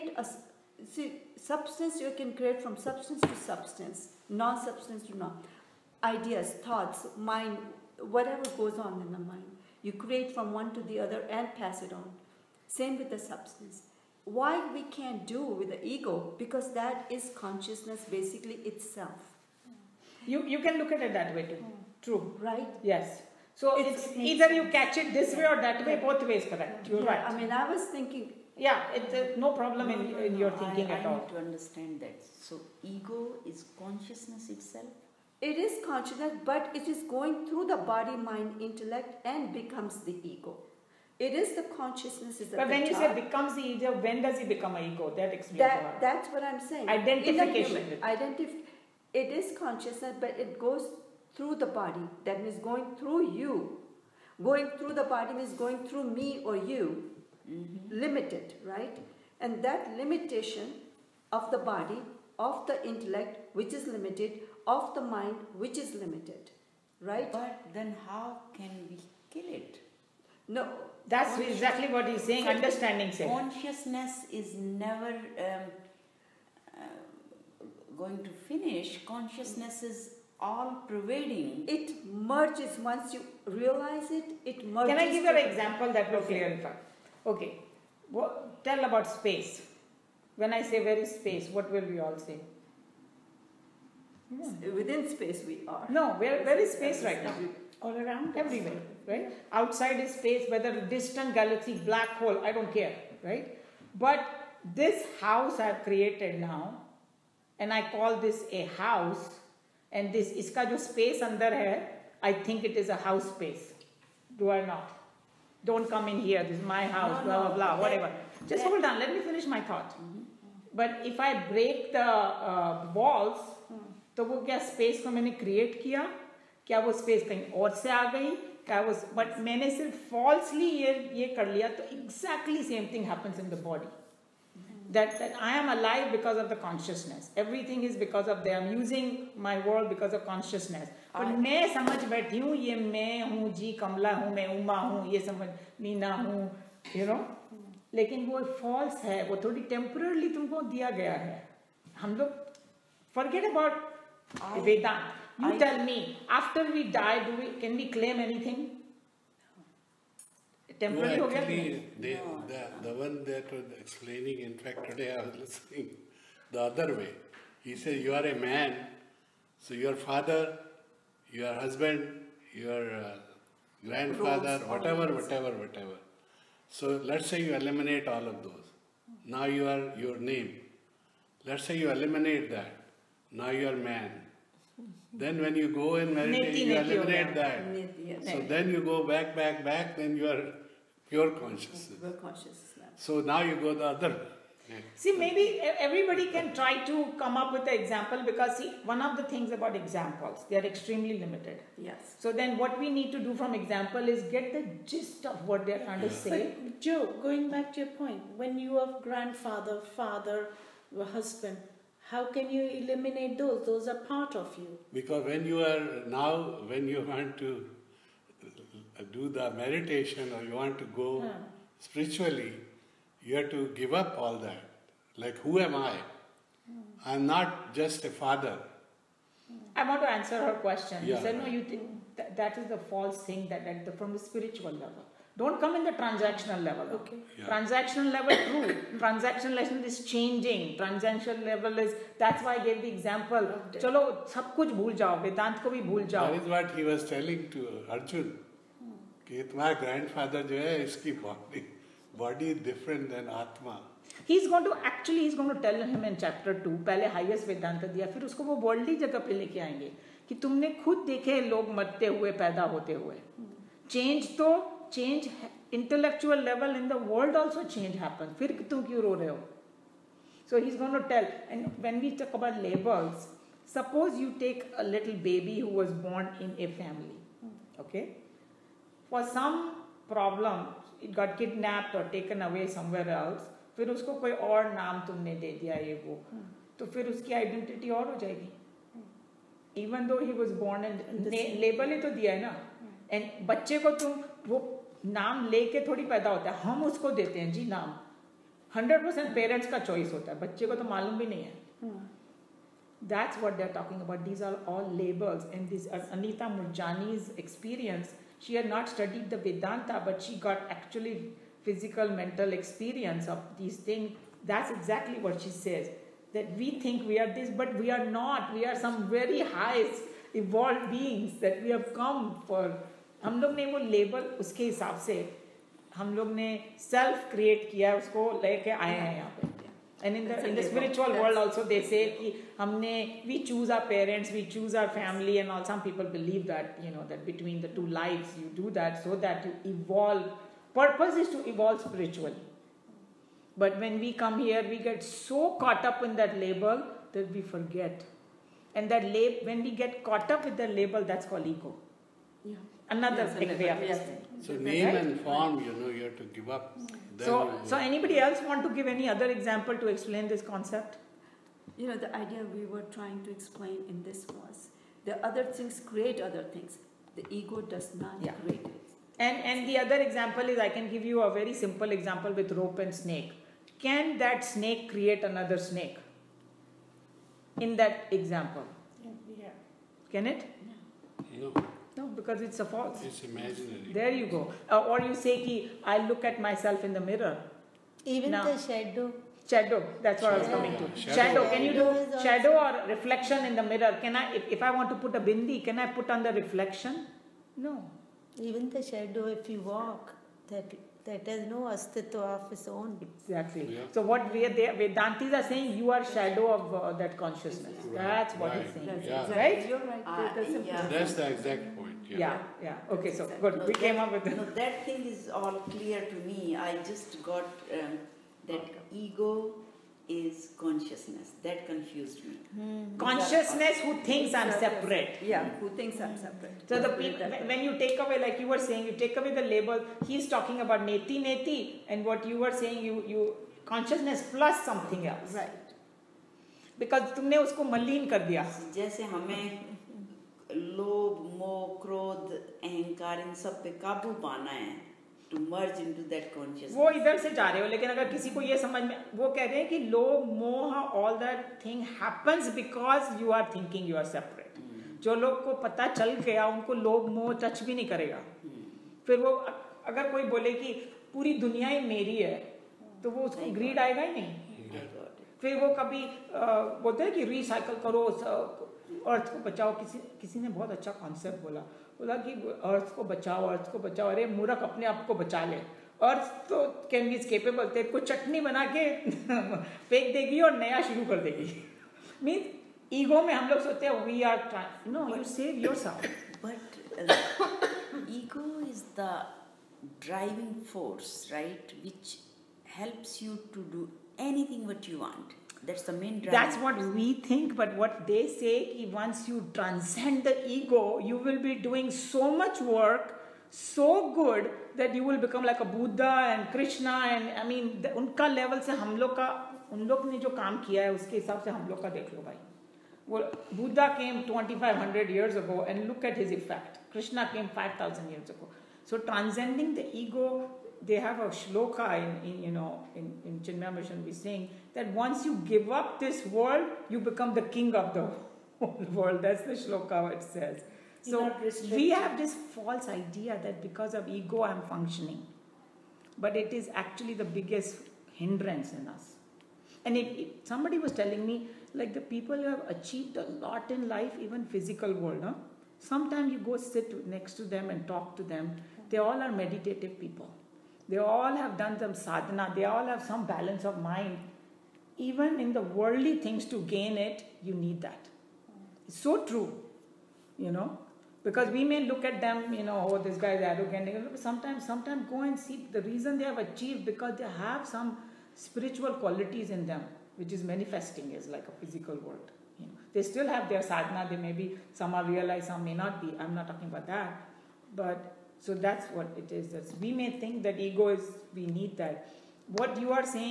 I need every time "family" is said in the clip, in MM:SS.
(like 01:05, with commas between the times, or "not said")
04:36, 05:34.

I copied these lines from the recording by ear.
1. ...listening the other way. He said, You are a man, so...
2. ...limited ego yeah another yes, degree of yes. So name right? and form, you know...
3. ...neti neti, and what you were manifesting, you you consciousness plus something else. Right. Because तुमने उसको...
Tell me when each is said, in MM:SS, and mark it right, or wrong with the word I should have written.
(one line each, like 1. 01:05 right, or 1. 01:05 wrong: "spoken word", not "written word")
1. 02:45 right
2. 05:51 wrong: "called", not "limited"
3. 07:10 wrong: "saying", not "manifesting".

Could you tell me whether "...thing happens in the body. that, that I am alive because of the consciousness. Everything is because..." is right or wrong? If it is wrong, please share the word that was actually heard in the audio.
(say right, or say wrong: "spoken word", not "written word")
right.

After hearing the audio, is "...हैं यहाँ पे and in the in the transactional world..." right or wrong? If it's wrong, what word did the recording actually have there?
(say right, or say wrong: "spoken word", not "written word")
wrong: "spiritual", not "transactional".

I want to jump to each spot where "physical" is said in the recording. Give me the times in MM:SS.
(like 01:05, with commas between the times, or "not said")
05:11, 09:04, 09:31.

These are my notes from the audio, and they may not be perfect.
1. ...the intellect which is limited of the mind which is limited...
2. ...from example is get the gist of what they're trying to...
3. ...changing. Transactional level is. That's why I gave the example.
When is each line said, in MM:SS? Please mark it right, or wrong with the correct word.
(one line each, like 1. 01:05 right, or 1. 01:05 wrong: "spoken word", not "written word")
1. 01:02 right
2. 03:23 right
3. 04:00 right.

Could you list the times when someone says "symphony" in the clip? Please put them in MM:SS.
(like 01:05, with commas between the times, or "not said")
not said.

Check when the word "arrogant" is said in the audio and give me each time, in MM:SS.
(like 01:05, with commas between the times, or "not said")
09:23.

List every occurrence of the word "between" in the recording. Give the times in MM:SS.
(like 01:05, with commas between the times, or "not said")
05:37.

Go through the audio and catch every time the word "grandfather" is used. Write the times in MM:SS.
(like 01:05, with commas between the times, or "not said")
02:53, 03:29.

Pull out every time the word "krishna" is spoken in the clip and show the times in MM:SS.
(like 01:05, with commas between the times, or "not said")
08:26, 08:36.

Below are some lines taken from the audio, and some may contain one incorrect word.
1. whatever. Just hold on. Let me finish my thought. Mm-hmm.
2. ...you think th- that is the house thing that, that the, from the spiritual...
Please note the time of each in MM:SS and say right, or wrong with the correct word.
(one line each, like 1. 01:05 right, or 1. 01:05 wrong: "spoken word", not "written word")
1. 01:57 right
2. 03:51 wrong: "false", not "house".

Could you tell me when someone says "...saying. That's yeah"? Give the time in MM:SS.
06:48.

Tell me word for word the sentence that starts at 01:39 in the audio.
Outside is space, whether distant galaxy, black hole, I don't care, right?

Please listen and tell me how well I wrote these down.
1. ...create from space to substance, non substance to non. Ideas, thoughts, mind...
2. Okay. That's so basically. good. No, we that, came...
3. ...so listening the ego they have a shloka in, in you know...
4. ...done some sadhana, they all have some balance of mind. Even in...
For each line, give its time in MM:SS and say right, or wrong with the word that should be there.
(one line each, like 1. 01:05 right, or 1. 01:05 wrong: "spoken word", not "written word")
1. 00:02 wrong: "substance", not "space"
2. 06:52 wrong: "exactly", not "basically"
3. 08:38 wrong: "transcending", not "listening"
4. 09:11 right.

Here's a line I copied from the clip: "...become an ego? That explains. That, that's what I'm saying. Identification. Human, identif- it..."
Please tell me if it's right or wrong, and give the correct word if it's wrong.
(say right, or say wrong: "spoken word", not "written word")
right.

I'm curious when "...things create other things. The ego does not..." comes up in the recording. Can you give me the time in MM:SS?
06:05.